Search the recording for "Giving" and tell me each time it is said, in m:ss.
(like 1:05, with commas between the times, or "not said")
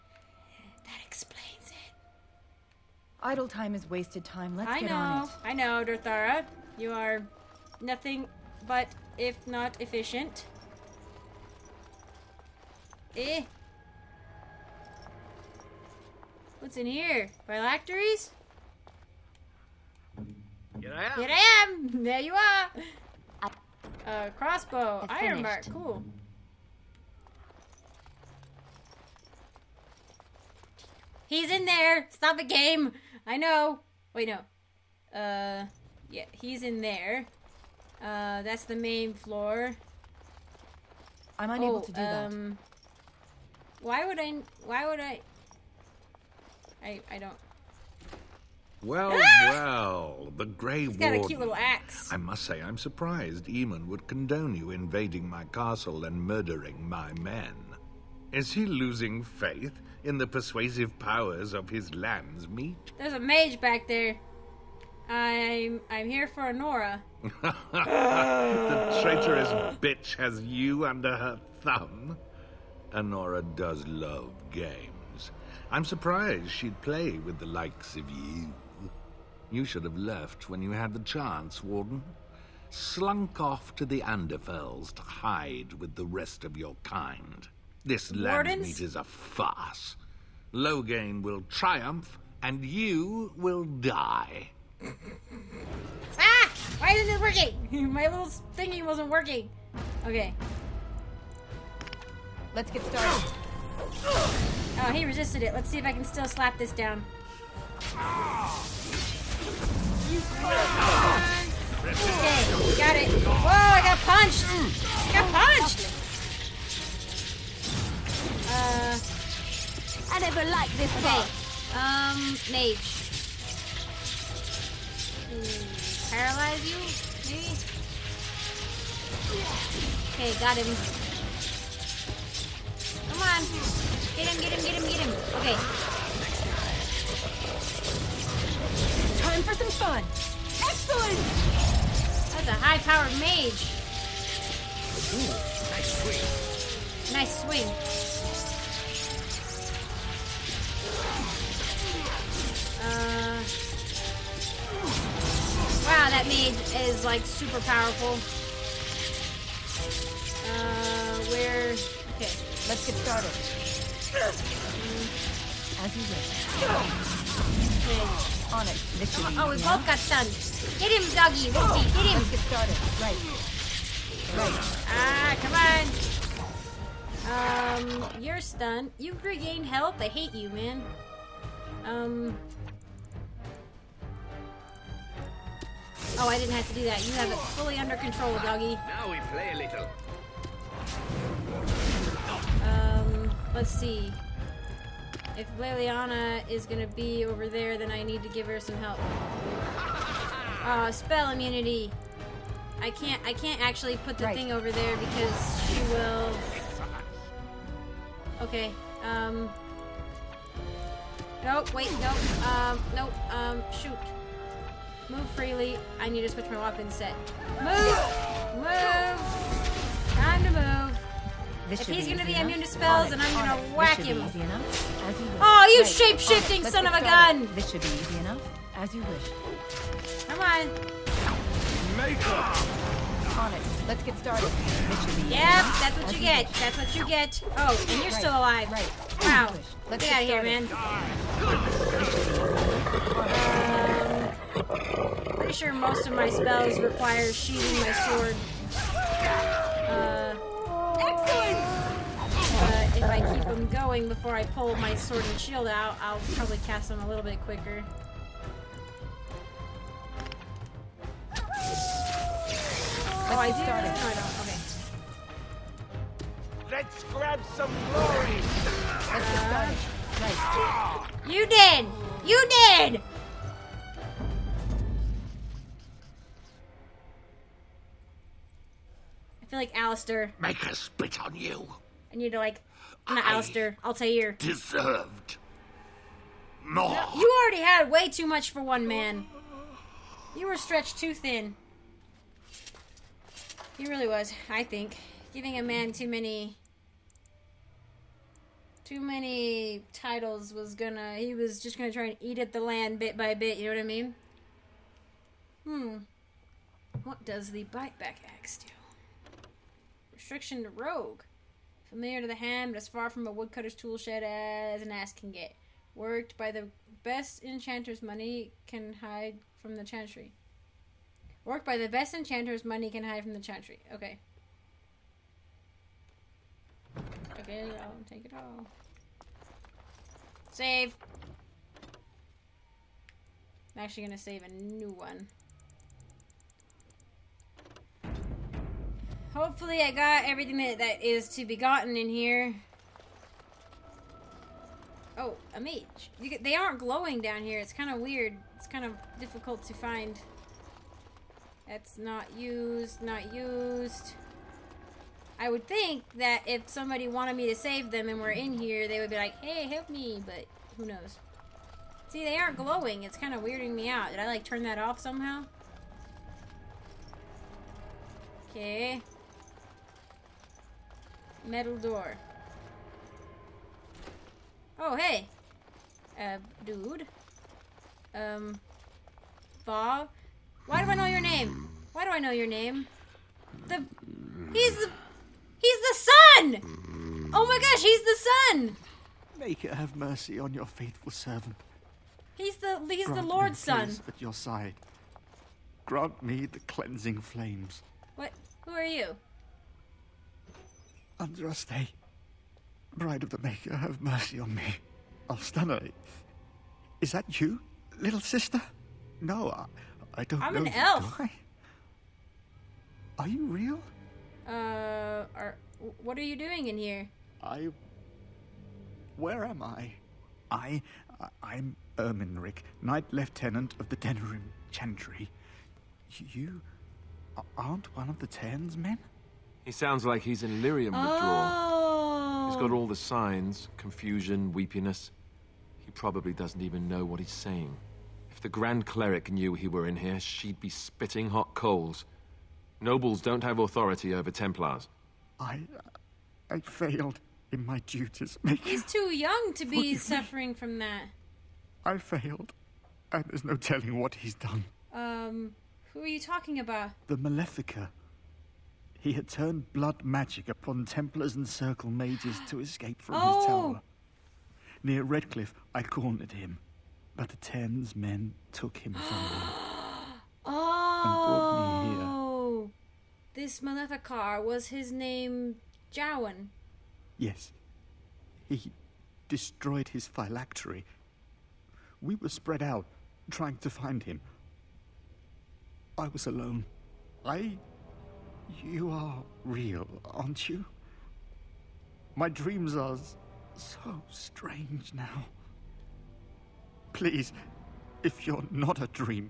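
4:55.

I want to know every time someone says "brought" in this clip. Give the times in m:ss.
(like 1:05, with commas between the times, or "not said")
7:50.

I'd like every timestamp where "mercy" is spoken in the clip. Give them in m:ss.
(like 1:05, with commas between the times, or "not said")
6:29, 6:44.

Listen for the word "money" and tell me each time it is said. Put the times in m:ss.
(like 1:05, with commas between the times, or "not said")
5:18, 5:22.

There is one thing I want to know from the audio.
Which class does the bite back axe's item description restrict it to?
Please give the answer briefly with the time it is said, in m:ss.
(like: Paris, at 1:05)
rogue, at 5:10.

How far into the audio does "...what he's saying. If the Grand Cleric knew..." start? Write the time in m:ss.
7:17.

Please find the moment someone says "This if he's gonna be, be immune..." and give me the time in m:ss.
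3:41.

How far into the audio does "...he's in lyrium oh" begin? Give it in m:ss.
7:10.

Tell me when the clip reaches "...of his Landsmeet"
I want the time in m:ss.
1:01.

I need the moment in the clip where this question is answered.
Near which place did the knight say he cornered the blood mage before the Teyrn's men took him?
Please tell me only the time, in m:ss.
7:45.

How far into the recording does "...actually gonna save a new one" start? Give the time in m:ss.
5:33.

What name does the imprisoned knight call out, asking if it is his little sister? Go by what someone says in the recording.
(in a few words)
Alfstanna.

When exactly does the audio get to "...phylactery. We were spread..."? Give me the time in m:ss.
8:00.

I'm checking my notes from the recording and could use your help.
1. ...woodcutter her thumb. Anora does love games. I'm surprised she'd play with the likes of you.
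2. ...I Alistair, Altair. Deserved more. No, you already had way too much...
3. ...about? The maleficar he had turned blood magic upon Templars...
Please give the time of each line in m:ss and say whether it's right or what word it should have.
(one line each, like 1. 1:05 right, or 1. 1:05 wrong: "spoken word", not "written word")
1. 1:10 wrong: "under", not "woodcutter"
2. 4:43 right
3. 7:36 right.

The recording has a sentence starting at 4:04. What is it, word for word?
Pretty sure most of my spells require sheathing my sword.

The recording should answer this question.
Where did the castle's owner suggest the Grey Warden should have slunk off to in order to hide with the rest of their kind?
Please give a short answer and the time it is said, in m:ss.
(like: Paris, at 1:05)
Anderfels, at 1:24.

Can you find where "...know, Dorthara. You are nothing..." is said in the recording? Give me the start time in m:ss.
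0:05.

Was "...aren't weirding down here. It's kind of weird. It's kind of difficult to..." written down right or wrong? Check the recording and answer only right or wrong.
wrong.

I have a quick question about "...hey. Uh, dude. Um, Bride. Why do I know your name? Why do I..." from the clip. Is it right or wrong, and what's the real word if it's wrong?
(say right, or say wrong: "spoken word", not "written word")
wrong: "Bob", not "Bride".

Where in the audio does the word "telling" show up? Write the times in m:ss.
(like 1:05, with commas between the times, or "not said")
7:33.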